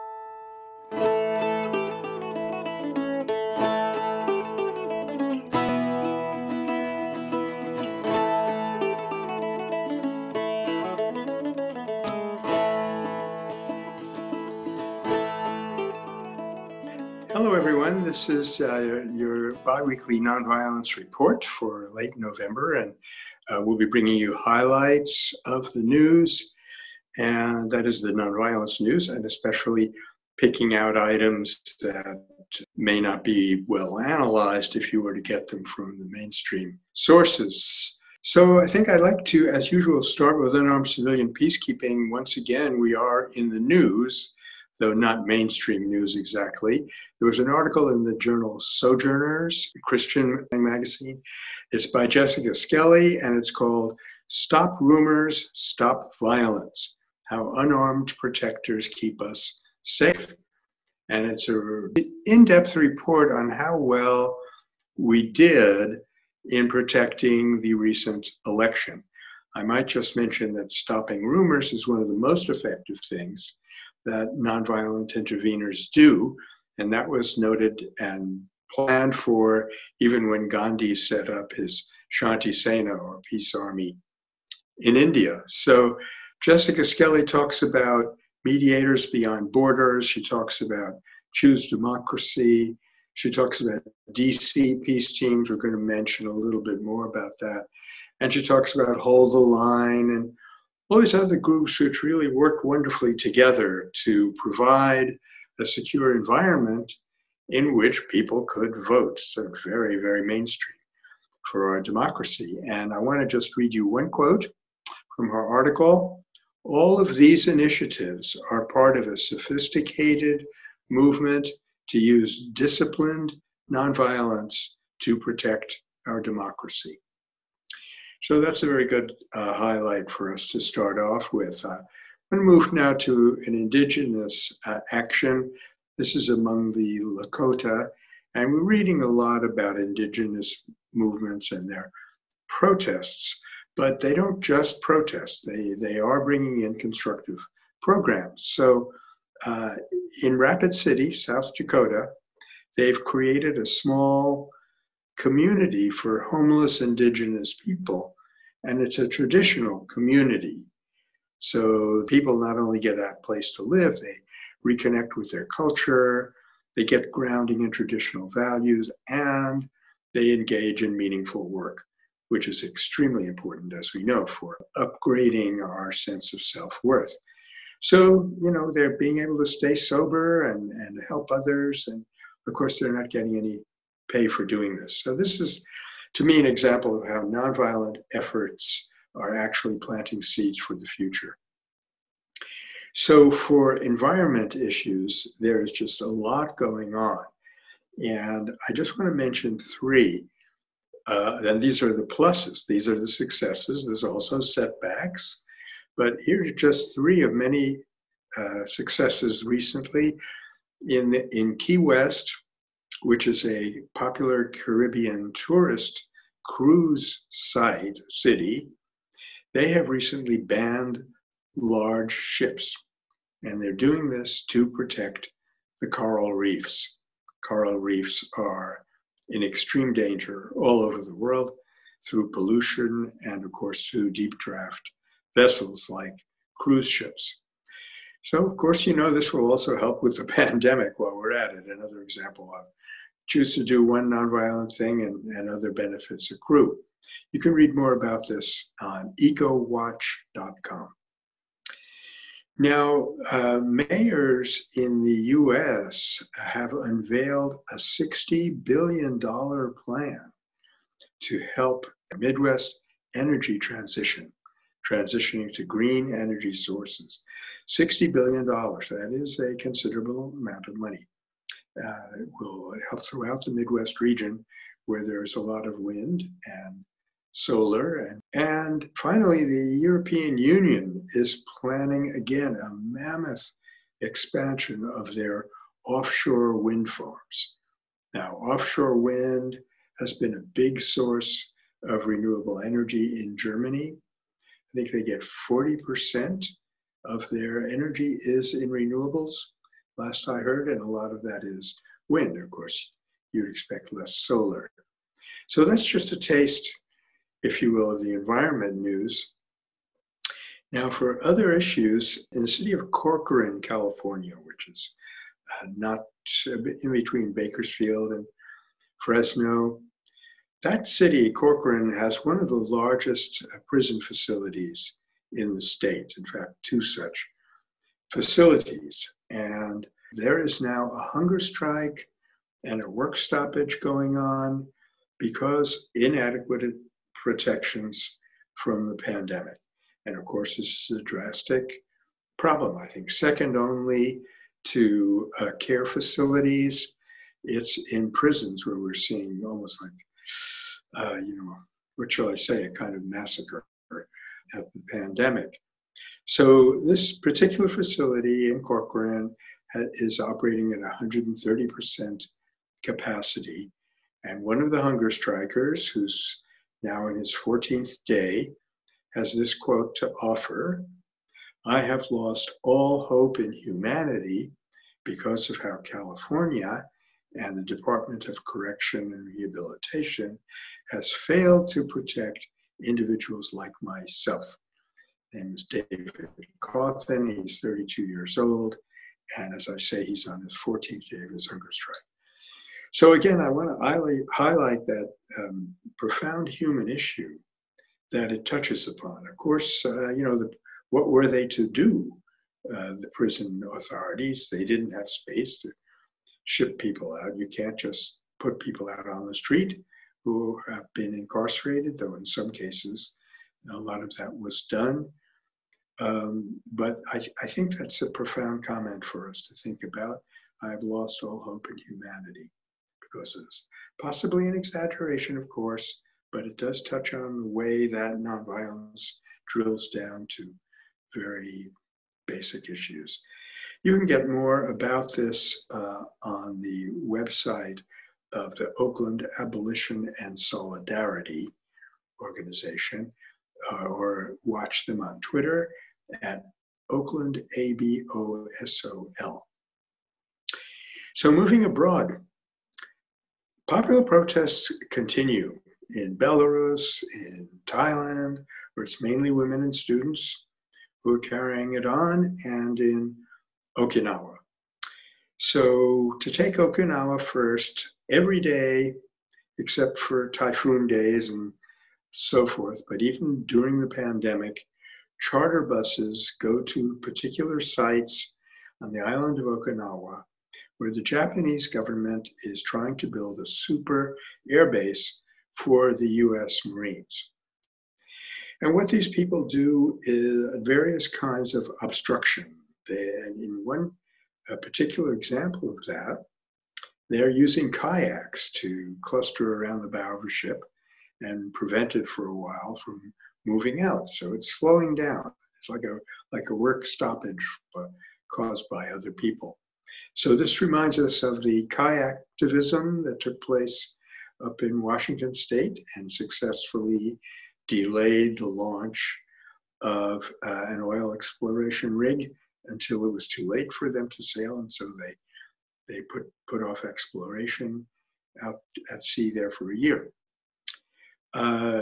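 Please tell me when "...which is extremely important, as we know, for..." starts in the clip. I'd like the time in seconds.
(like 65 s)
172 s.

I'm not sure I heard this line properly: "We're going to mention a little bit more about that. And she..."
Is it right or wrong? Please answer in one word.
right.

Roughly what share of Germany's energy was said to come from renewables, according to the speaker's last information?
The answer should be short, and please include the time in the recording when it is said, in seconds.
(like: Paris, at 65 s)
40%, at 295 s.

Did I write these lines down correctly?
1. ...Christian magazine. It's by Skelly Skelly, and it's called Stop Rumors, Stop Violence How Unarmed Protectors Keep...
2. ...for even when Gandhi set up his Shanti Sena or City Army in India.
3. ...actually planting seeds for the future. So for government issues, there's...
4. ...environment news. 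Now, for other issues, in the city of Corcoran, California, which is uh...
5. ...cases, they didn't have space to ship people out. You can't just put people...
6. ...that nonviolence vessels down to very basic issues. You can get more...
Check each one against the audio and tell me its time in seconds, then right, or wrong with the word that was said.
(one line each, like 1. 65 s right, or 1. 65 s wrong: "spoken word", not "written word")
1. 49 s wrong: "Jessica", not "Skelly"
2. 79 s wrong: "Peace", not "City"
3. 189 s wrong: "environment", not "government"
4. 308 s right
5. 403 s wrong: "authorities", not "cases"
6. 427 s wrong: "drills", not "vessels".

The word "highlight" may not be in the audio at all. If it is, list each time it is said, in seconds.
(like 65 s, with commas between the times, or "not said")
24 s, 129 s, 394 s.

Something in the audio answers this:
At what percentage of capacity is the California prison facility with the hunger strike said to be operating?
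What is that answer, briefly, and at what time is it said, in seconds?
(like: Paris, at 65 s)
130%, at 360 s.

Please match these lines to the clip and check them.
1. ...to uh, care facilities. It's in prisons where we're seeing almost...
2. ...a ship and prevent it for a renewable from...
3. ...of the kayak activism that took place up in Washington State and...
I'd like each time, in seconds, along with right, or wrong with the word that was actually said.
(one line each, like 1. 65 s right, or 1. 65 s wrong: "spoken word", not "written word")
1. 344 s right
2. 500 s wrong: "while", not "renewable"
3. 511 s right.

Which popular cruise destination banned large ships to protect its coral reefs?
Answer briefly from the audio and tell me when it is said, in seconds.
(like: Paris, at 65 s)
Key West, at 211 s.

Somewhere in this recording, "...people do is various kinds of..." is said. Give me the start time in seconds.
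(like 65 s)
489 s.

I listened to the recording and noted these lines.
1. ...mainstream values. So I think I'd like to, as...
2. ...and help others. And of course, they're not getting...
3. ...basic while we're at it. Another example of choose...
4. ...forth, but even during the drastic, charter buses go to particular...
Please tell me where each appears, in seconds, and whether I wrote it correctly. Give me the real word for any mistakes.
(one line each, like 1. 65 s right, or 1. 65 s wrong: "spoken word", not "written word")
1. 36 s wrong: "sources", not "values"
2. 180 s right
3. 240 s wrong: "pandemic", not "basic"
4. 472 s wrong: "pandemic", not "drastic".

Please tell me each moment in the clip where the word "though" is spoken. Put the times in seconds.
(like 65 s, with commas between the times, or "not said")
44 s, 411 s.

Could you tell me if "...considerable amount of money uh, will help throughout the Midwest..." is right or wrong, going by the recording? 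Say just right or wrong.
right.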